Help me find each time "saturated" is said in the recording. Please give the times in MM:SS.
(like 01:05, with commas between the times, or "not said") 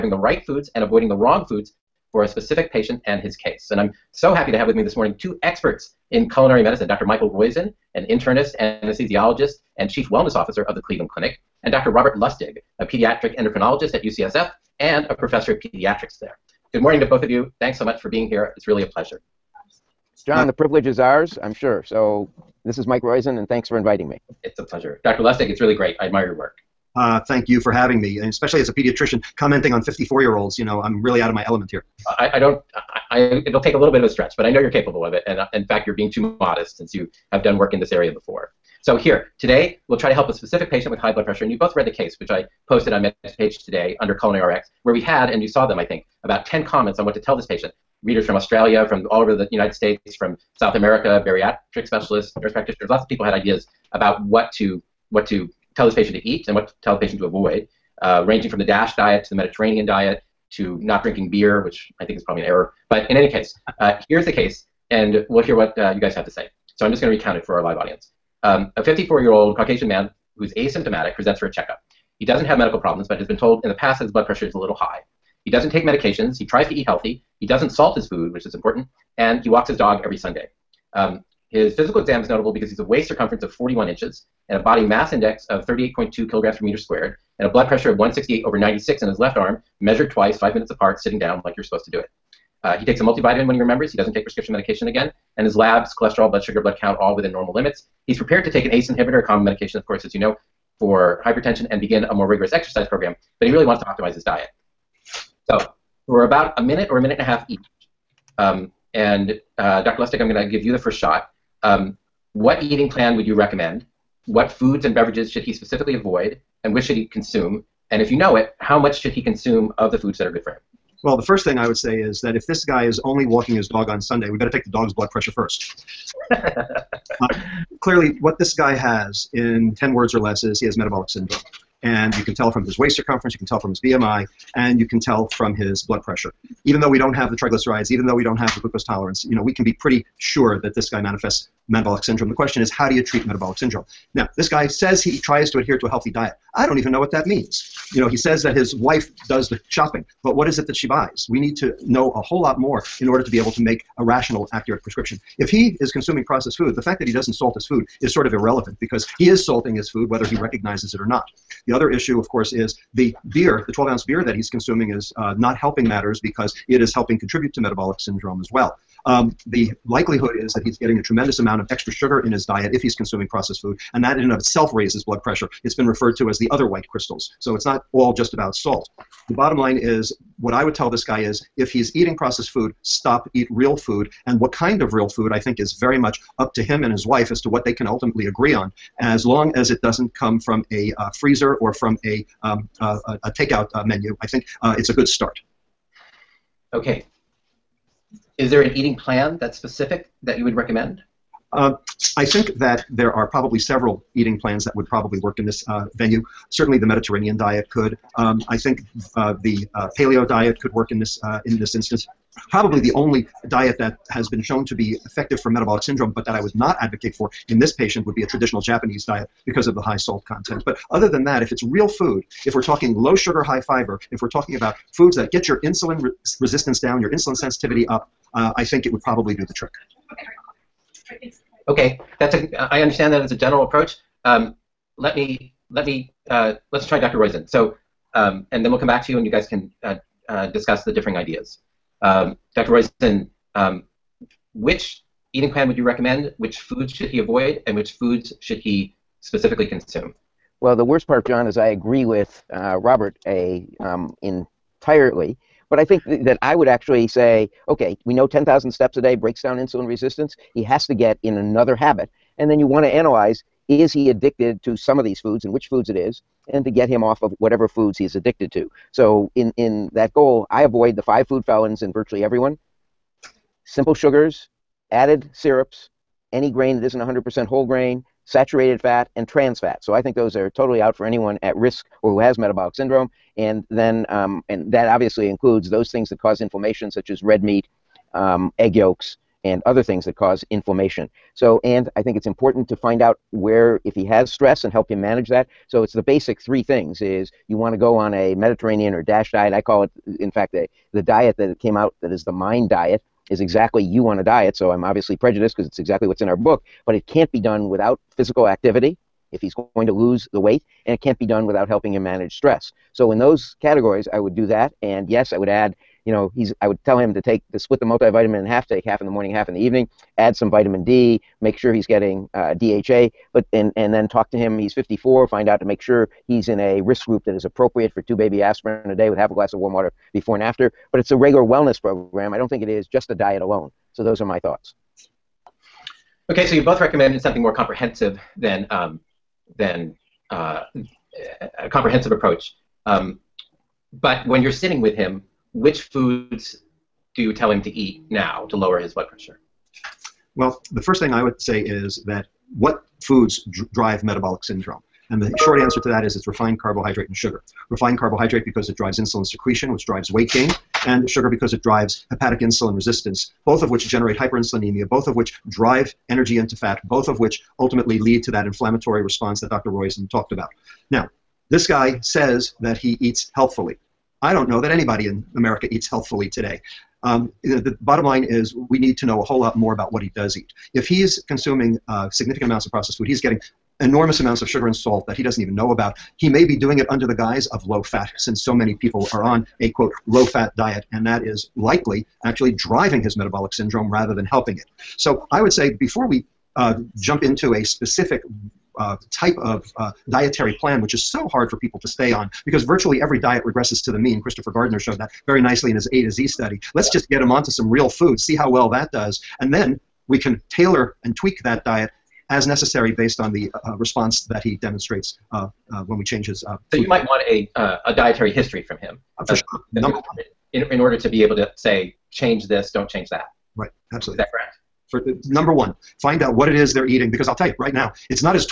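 04:38.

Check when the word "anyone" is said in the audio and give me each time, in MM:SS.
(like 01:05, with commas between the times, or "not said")
04:41.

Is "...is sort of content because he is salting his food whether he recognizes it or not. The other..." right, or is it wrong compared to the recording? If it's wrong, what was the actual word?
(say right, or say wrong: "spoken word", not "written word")
wrong: "irrelevant", not "content".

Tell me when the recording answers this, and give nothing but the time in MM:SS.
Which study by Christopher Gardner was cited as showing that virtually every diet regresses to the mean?
06:45.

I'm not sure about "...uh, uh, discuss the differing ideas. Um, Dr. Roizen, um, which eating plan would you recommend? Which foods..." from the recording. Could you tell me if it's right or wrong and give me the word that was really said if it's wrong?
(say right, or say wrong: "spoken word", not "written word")
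right.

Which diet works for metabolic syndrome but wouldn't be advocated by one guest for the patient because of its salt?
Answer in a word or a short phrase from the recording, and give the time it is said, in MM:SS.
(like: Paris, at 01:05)
traditional Japanese diet, at 03:38.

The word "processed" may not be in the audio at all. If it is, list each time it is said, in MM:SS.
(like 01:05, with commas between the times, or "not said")
02:36, 02:53, 03:02, 06:22.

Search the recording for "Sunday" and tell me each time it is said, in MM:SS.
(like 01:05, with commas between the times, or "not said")
01:20, 02:04.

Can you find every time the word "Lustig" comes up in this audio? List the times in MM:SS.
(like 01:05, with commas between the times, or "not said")
00:12, 00:25, 01:50.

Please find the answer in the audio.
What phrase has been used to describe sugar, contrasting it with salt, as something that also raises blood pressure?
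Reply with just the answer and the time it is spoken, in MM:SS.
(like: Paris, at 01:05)
the other white crystals, at 02:56.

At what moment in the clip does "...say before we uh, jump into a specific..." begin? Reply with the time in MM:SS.
06:35.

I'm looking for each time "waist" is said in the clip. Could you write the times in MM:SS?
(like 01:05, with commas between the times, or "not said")
01:22, 02:12.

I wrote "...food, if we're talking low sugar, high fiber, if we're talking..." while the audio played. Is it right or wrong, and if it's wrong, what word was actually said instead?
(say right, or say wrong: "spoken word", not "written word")
right.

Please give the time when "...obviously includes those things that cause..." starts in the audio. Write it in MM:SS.
04:44.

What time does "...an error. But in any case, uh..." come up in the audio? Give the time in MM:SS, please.
01:02.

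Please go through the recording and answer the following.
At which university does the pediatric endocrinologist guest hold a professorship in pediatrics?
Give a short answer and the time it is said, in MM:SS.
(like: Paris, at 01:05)
UCSF, at 00:14.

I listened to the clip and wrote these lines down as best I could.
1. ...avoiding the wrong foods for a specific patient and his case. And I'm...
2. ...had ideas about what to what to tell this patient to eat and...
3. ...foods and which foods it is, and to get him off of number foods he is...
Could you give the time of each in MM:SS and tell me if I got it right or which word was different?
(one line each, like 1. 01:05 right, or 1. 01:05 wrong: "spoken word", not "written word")
1. 00:00 right
2. 00:53 right
3. 04:25 wrong: "whatever", not "number".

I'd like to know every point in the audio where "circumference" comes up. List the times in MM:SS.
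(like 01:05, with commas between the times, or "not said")
01:23, 02:12.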